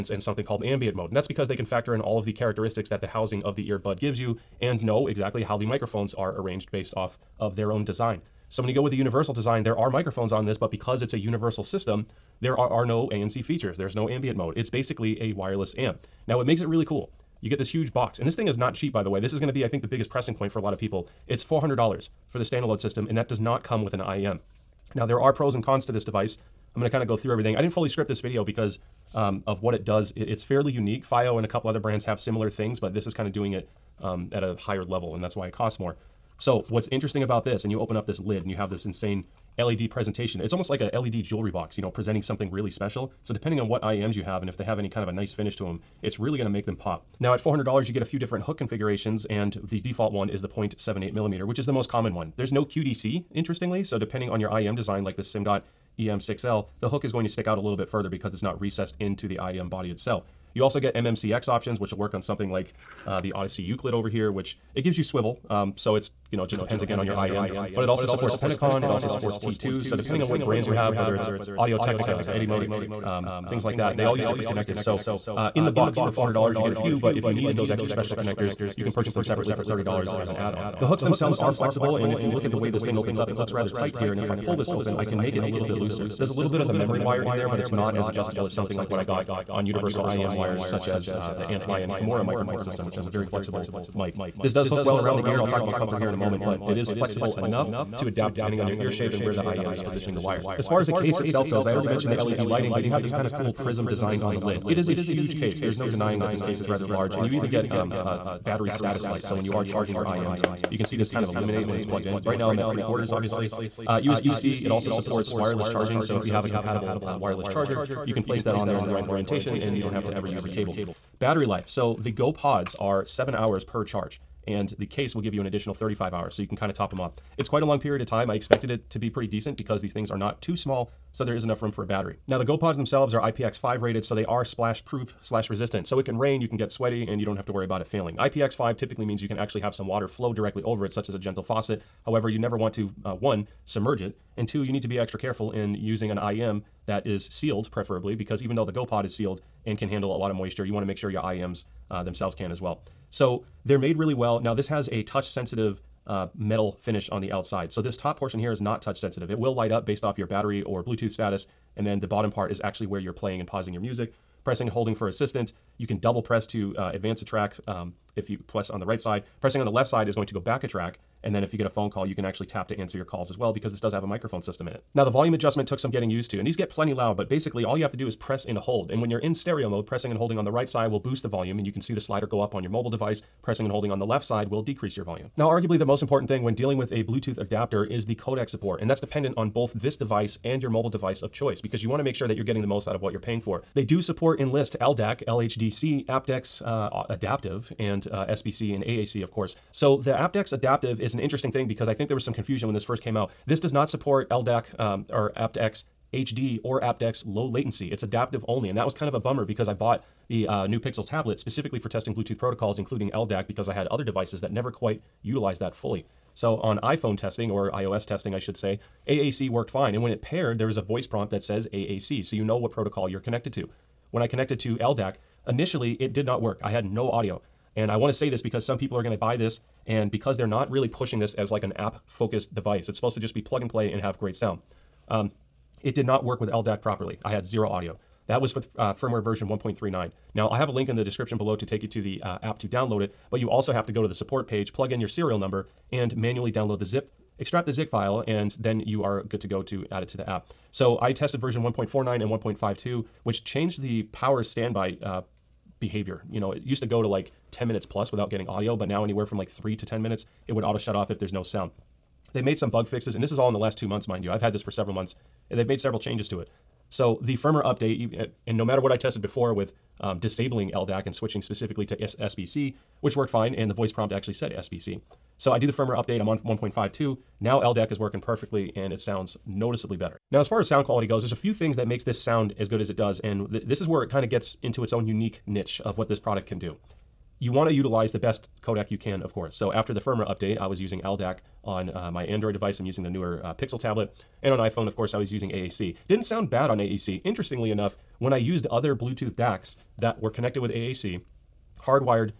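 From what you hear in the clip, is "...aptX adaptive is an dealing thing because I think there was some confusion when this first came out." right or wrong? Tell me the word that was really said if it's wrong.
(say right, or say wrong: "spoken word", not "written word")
wrong: "interesting", not "dealing".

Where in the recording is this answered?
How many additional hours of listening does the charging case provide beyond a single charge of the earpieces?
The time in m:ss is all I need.
2:05.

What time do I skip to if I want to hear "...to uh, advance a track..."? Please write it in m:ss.
2:46.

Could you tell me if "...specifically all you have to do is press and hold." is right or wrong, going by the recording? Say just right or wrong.
wrong.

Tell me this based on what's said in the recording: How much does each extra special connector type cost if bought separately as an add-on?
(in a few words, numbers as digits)
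$30.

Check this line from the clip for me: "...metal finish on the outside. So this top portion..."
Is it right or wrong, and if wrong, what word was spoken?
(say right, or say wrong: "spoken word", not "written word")
right.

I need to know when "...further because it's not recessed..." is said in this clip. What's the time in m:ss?
0:57.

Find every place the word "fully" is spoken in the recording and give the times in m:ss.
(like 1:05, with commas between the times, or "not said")
0:27, 3:35.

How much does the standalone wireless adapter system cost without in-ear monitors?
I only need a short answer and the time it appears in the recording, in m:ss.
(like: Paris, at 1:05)
$400, at 0:21.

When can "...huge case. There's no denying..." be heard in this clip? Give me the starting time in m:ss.
1:44.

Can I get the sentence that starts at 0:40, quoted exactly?
It's almost like a LED jewelry box, you know, presenting something really special.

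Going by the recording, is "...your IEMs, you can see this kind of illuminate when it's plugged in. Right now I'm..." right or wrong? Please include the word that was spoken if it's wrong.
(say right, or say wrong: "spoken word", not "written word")
right.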